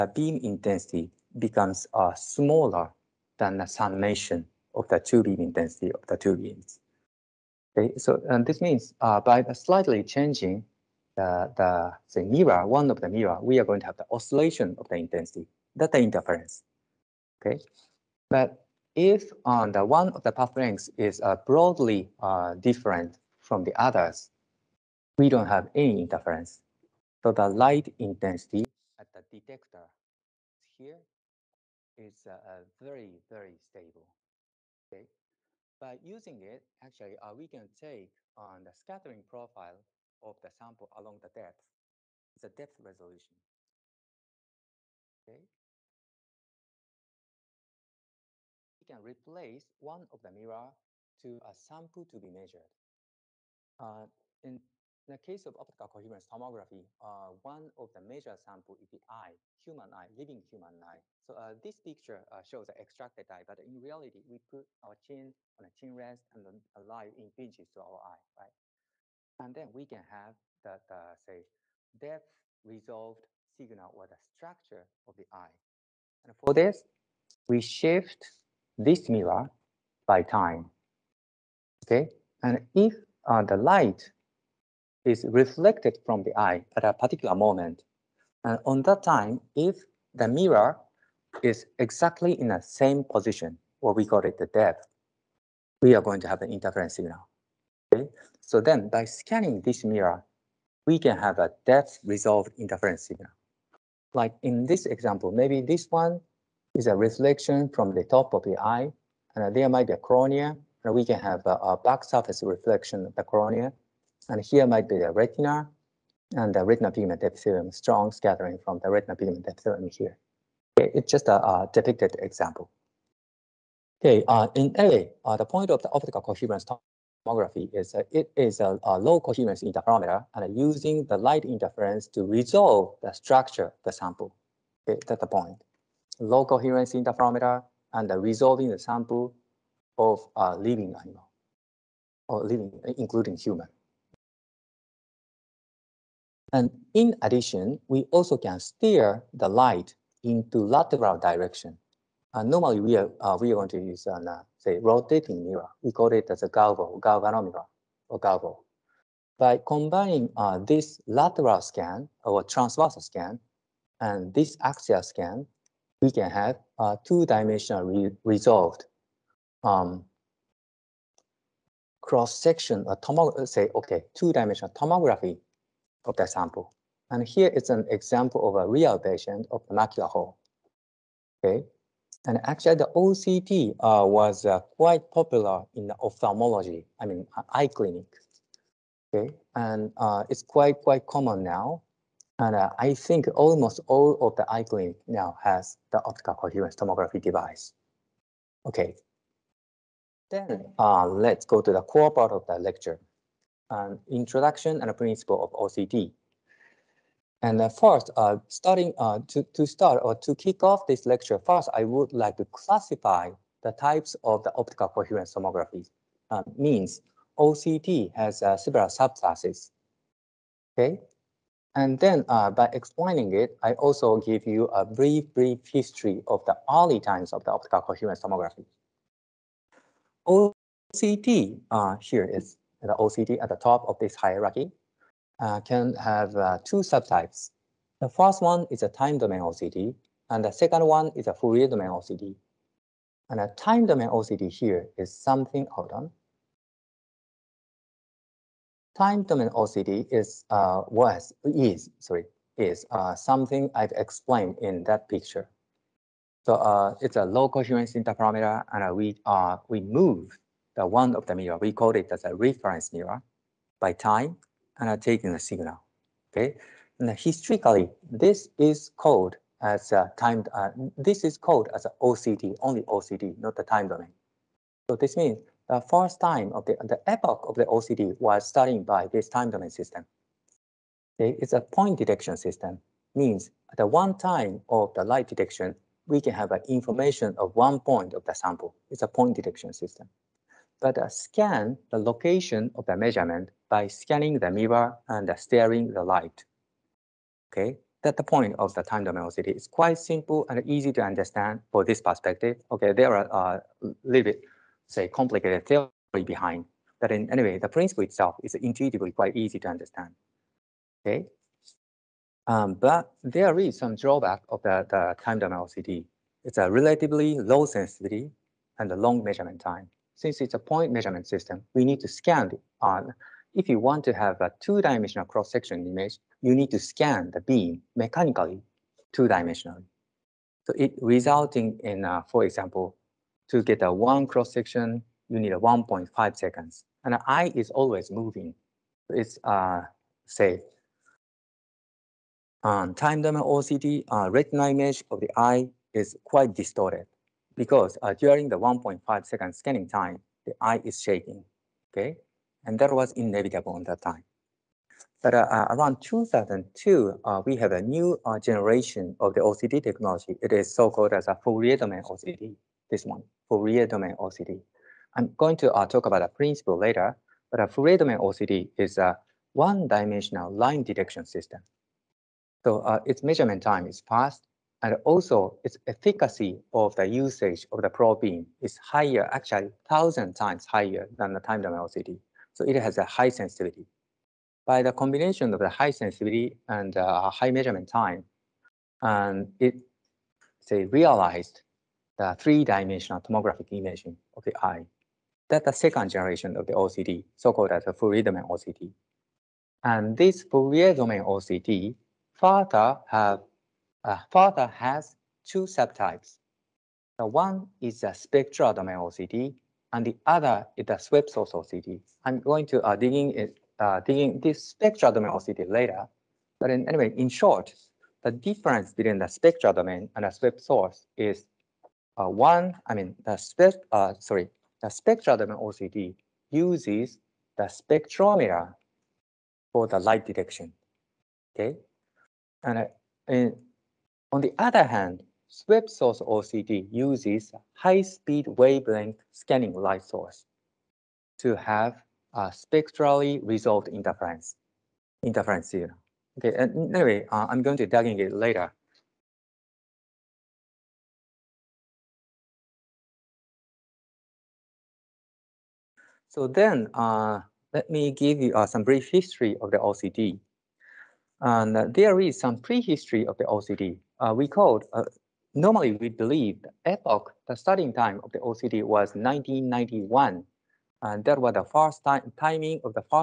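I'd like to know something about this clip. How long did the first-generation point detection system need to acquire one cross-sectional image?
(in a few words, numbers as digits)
1.5 seconds.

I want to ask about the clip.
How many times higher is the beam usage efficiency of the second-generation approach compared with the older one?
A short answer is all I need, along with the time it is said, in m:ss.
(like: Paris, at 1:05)
1,000 times, at 6:19.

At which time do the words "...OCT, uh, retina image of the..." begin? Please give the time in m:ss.
5:43.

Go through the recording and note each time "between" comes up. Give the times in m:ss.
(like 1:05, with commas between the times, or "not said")
6:58.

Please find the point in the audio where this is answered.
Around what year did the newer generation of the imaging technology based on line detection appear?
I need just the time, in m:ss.
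5:56.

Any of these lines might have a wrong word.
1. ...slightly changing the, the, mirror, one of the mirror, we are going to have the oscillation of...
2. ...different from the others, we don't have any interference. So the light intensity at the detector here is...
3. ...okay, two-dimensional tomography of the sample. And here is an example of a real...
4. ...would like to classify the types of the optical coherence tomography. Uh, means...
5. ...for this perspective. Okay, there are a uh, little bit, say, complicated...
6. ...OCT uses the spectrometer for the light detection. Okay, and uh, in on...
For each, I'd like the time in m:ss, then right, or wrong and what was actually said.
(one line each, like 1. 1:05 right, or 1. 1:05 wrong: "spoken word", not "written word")
1. 0:09 right
2. 0:22 right
3. 2:53 right
4. 3:31 right
5. 5:01 right
6. 7:05 right.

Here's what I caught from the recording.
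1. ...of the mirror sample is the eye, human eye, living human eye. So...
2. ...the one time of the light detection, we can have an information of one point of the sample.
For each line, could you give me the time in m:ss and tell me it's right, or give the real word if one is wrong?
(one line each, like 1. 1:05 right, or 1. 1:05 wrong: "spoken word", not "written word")
1. 0:57 wrong: "major", not "mirror"
2. 4:43 right.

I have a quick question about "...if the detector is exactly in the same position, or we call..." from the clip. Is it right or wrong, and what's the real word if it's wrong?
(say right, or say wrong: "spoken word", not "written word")
wrong: "mirror", not "detector".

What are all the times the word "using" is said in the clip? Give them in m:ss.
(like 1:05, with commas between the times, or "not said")
0:36, 2:10.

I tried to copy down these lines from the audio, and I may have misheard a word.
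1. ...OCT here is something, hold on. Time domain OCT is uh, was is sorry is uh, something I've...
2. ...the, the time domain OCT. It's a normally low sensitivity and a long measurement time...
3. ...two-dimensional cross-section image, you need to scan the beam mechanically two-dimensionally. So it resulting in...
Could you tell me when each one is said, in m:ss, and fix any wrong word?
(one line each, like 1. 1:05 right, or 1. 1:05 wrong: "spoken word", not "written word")
1. 4:04 right
2. 5:14 wrong: "relatively", not "normally"
3. 5:24 right.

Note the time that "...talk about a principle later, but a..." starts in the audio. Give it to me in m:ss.
6:05.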